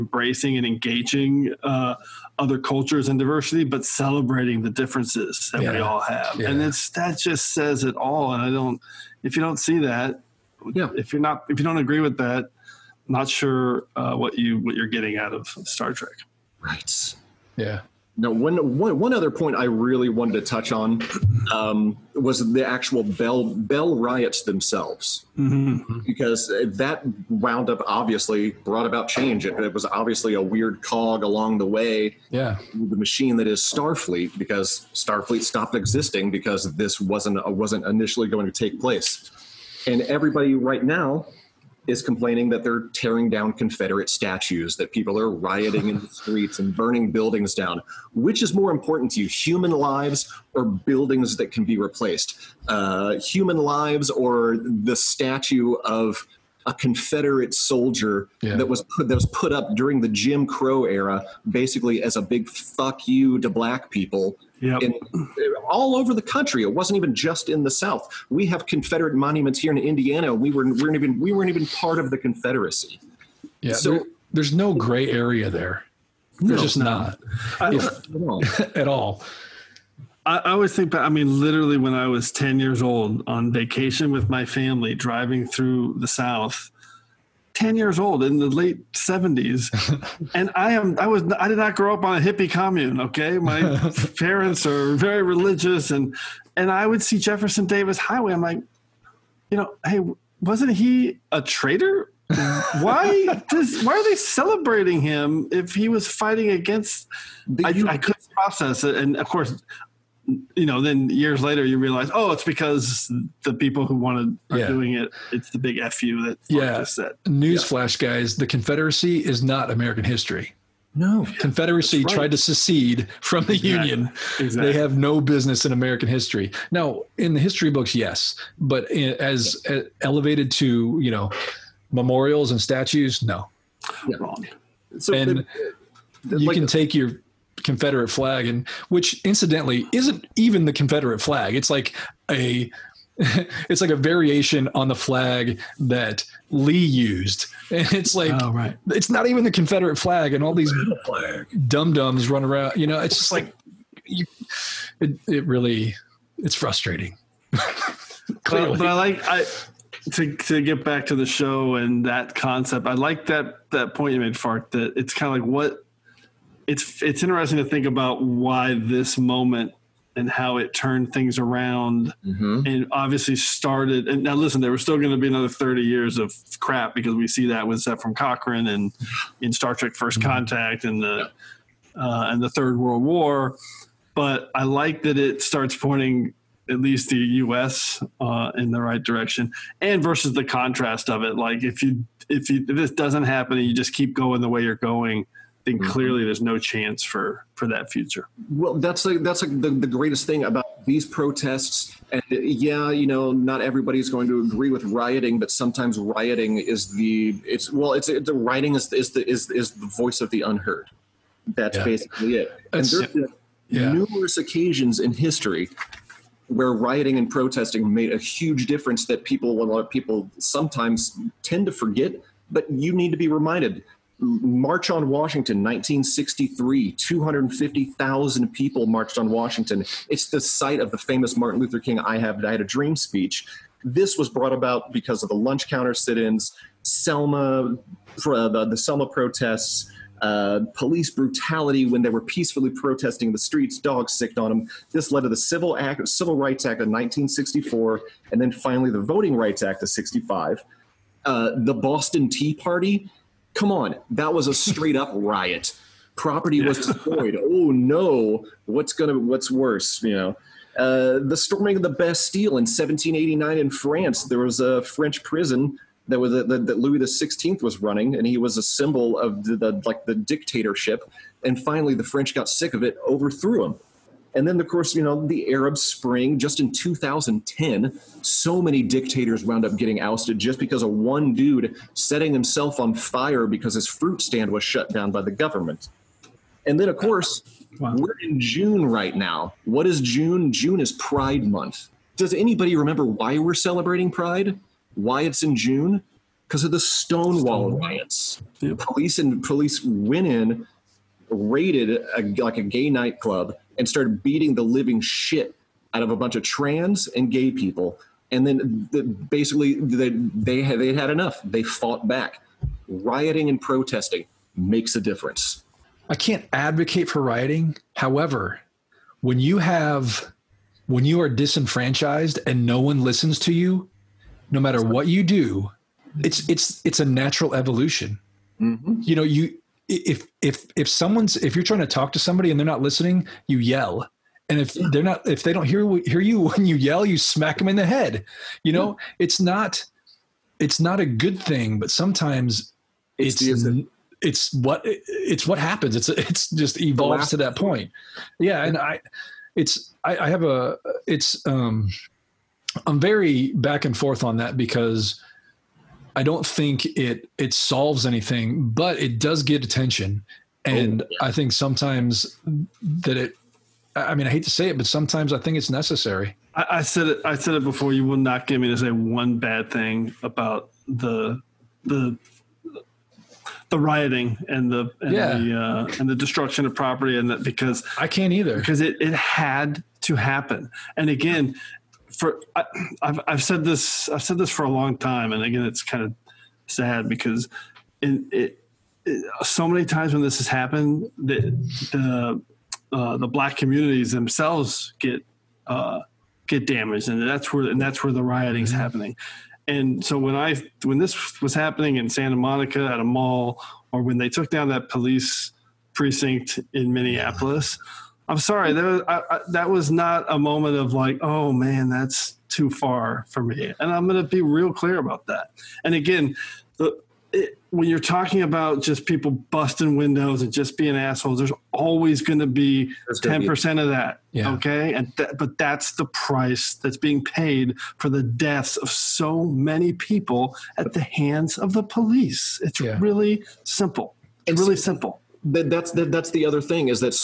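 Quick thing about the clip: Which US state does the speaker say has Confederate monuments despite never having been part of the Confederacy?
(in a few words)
Indiana.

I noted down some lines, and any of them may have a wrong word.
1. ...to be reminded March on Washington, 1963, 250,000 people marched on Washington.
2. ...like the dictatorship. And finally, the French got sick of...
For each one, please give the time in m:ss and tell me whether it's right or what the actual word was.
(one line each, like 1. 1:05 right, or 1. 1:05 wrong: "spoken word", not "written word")
1. 3:43 right
2. 4:29 right.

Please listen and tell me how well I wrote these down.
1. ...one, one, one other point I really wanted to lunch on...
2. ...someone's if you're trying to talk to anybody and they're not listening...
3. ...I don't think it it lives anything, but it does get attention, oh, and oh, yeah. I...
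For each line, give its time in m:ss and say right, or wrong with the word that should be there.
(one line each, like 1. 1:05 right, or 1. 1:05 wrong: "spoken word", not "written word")
1. 0:18 wrong: "touch", not "lunch"
2. 5:30 wrong: "somebody", not "anybody"
3. 5:56 wrong: "solves", not "lives".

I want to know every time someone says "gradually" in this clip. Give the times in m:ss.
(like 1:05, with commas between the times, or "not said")
not said.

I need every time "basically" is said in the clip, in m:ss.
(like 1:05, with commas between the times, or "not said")
1:01, 3:31, 5:09.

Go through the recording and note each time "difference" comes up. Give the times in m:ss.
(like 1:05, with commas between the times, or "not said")
0:04, 3:38, 5:15.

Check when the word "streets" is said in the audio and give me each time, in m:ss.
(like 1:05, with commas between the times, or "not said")
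0:46, 4:03.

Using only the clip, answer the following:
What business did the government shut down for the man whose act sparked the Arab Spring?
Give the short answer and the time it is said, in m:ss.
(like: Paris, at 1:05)
fruit stand, at 4:43.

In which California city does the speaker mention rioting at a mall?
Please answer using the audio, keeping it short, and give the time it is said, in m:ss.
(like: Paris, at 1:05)
Santa Monica, at 6:42.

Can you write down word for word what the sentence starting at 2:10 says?
elevated to you know memorials and statues, no.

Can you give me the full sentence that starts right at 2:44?
That it's kind of like what it's it's interesting to think about why this moment and how it turned things around mm-hmm.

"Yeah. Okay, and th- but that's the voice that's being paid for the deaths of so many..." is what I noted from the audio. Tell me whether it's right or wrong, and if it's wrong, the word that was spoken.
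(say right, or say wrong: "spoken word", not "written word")
wrong: "price", not "voice".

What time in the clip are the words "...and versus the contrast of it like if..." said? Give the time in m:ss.
3:09.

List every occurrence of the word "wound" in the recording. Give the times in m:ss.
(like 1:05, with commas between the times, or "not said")
0:27, 4:39.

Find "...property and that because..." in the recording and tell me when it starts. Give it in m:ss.
6:16.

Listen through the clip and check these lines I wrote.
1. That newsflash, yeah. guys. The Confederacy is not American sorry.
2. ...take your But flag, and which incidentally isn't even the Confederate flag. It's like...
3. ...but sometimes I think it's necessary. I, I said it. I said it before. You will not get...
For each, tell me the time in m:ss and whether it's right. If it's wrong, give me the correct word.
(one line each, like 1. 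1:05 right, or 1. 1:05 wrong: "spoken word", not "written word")
1. 1:56 wrong: "history", not "sorry"
2. 2:16 wrong: "Confederate", not "But"
3. 6:04 right.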